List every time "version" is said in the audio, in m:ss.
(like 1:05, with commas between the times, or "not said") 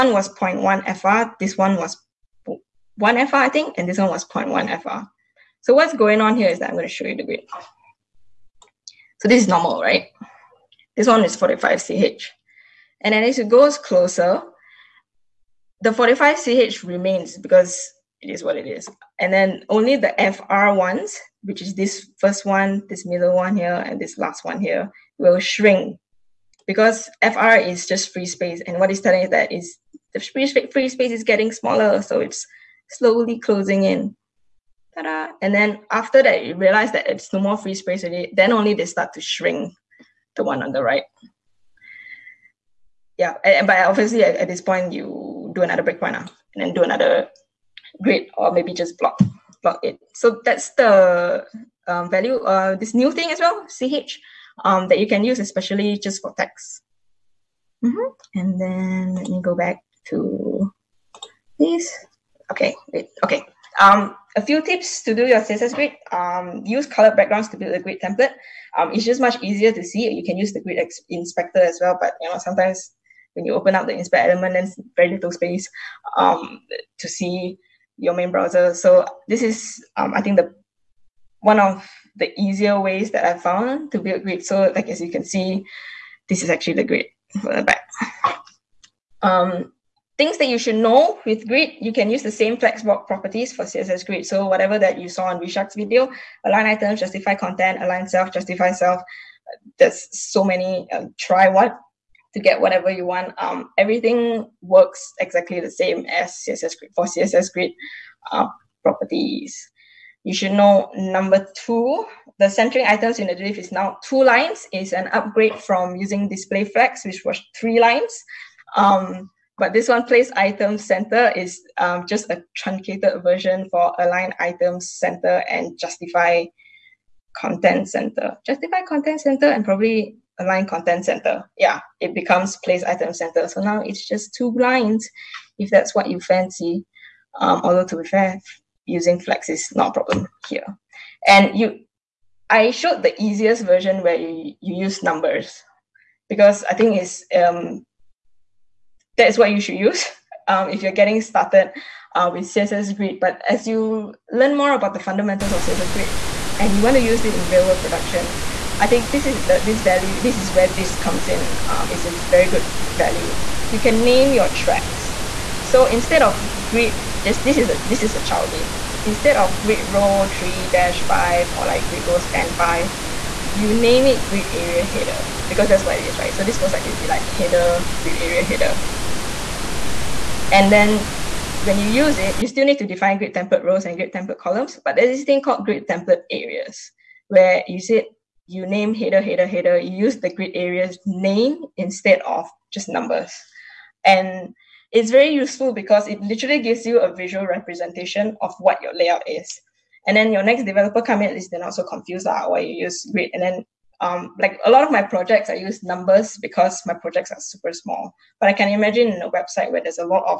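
2:03, 2:23.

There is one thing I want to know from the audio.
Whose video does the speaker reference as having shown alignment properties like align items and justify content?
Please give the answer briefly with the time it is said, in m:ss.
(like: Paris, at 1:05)
Vishak, at 1:35.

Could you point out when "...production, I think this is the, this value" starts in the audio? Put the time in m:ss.
2:37.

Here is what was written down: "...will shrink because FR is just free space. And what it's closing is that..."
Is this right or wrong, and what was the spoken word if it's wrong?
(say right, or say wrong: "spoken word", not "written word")
wrong: "telling", not "closing".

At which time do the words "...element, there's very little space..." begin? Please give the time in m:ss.
1:14.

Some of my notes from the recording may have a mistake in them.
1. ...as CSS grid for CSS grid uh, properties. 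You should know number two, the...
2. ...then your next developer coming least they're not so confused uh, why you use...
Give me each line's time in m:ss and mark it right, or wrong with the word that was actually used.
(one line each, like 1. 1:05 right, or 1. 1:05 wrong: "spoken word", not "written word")
1. 1:46 right
2. 3:20 right.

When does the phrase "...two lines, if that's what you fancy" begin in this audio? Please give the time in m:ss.
2:14.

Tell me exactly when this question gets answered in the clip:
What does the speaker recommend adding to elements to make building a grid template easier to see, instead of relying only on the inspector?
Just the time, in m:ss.
1:06.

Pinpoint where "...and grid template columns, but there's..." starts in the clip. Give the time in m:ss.
3:03.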